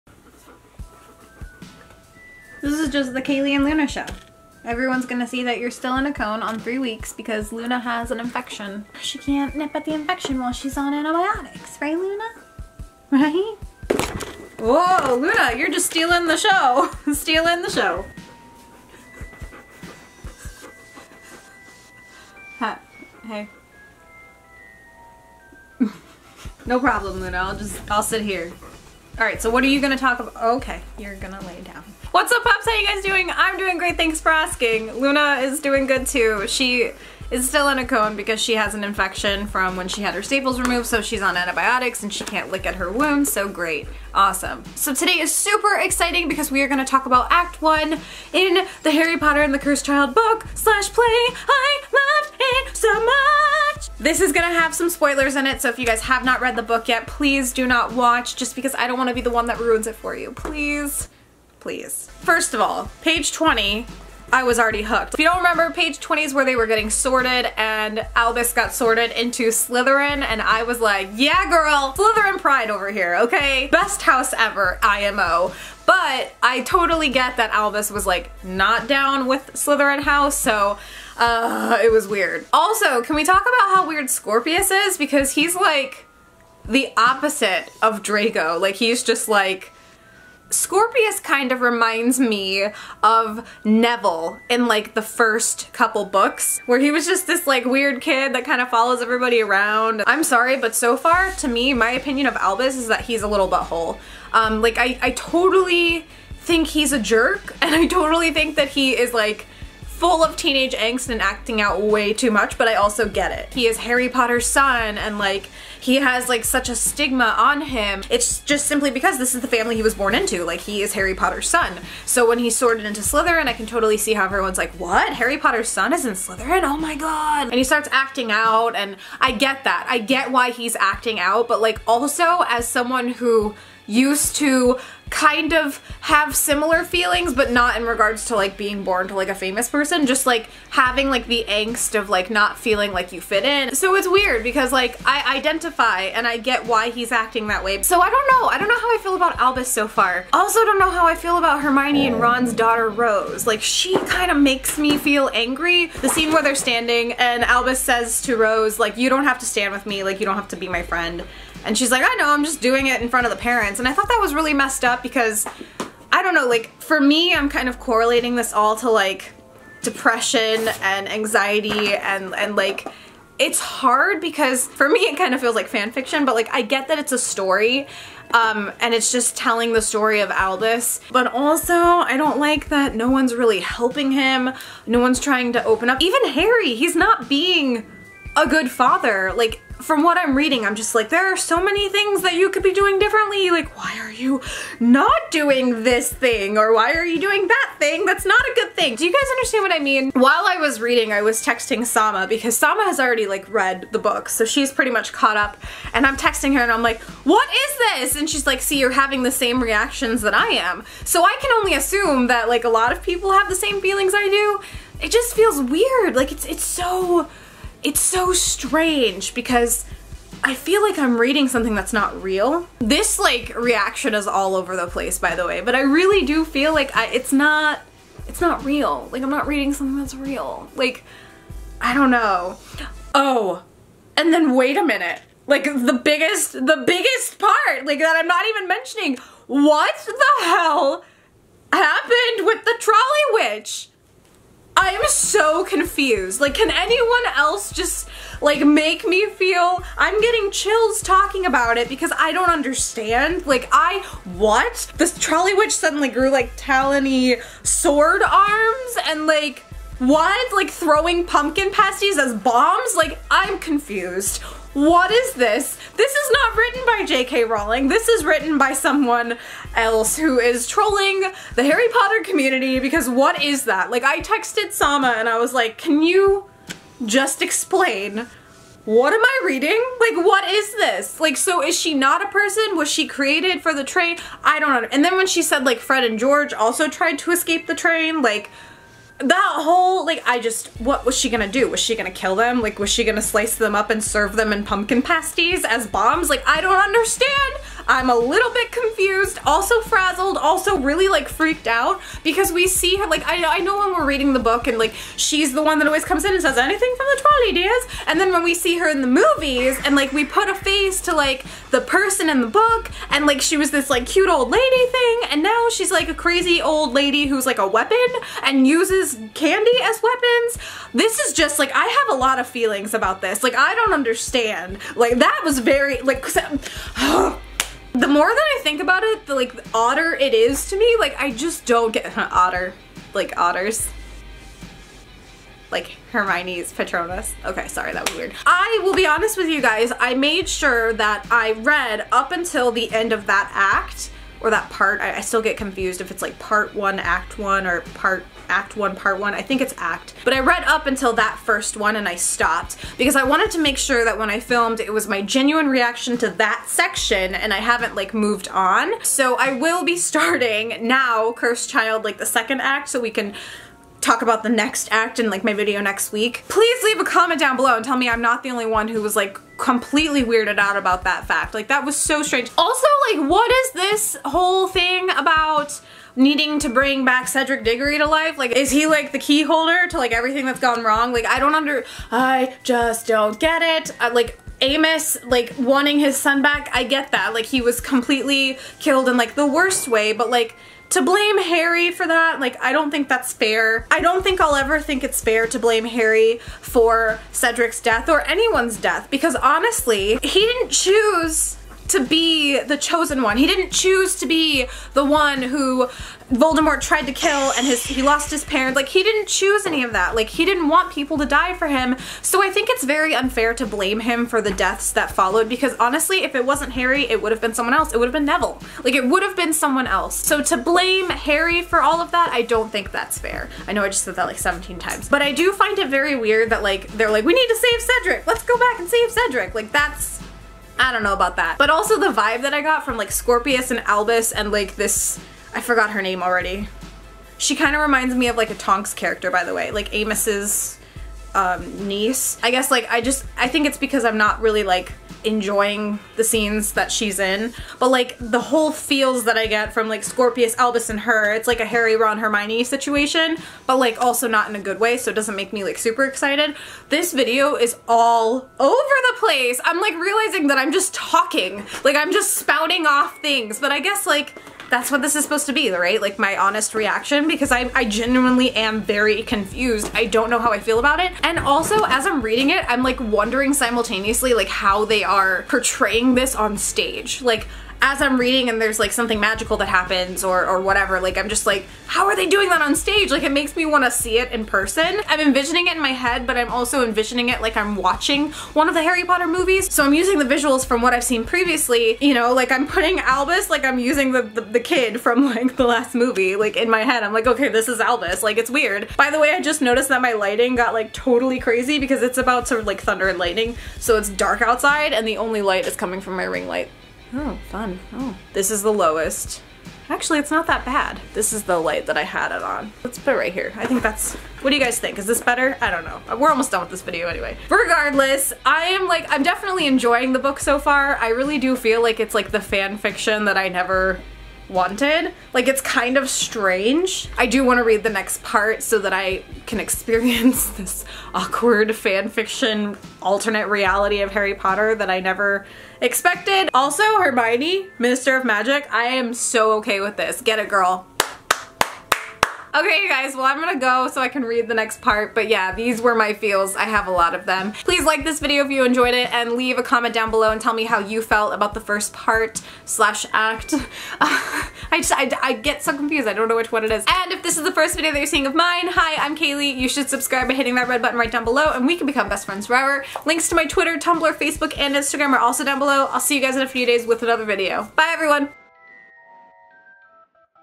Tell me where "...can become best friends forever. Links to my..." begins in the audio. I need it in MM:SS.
09:21.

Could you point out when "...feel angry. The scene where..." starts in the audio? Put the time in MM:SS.
02:34.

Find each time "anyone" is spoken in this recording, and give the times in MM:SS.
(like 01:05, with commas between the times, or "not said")
04:06, 06:38.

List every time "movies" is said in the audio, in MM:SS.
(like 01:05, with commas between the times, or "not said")
05:09, 08:09, 08:15.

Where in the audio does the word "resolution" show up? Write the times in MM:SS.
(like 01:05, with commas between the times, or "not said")
not said.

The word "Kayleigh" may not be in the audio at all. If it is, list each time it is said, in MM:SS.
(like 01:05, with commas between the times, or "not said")
00:03, 09:19.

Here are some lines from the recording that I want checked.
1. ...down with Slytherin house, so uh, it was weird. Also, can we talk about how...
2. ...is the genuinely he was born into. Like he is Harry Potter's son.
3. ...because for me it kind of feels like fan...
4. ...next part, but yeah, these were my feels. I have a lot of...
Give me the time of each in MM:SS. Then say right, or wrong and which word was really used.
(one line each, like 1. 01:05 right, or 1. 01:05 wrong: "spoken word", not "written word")
1. 01:18 right
2. 01:59 wrong: "family", not "genuinely"
3. 02:54 right
4. 09:04 right.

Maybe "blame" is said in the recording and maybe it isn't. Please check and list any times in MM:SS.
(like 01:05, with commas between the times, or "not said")
06:31, 06:35, 06:53, 07:00.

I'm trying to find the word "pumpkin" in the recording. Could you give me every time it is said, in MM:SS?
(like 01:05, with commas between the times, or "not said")
04:21, 04:54.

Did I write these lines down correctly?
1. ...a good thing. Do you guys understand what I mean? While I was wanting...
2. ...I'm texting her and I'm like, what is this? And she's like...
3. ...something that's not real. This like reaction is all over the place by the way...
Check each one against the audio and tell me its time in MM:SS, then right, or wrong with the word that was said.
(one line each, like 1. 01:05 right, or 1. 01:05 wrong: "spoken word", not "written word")
1. 03:18 wrong: "reading", not "wanting"
2. 03:26 right
3. 03:41 right.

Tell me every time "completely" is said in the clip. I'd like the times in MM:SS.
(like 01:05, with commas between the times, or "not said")
06:09, 06:27.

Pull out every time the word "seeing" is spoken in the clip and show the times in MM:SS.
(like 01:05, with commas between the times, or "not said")
09:18.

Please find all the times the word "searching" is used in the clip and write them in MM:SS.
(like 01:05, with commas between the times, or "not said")
not said.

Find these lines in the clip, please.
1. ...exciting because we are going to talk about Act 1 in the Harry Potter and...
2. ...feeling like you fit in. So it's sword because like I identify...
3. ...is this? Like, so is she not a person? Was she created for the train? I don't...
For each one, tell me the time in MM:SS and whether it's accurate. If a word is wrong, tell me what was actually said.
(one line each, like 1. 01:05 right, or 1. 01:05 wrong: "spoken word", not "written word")
1. 00:45 right
2. 02:22 wrong: "weird", not "sword"
3. 04:40 right.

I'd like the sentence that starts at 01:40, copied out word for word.
I'm sorry but so far to me my opinion of Albus is that he's a little butthole.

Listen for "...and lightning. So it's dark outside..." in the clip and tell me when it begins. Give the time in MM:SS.
08:23.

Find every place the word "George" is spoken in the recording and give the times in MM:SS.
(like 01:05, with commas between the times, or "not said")
04:46.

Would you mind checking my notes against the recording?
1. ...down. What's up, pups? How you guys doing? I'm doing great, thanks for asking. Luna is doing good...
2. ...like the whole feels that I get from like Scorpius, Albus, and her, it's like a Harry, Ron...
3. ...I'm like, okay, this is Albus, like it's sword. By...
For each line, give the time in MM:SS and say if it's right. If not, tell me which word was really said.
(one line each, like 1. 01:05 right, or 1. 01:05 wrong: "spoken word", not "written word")
1. 00:31 right
2. 07:27 right
3. 08:17 wrong: "weird", not "sword".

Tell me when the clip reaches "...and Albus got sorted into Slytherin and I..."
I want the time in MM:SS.
01:07.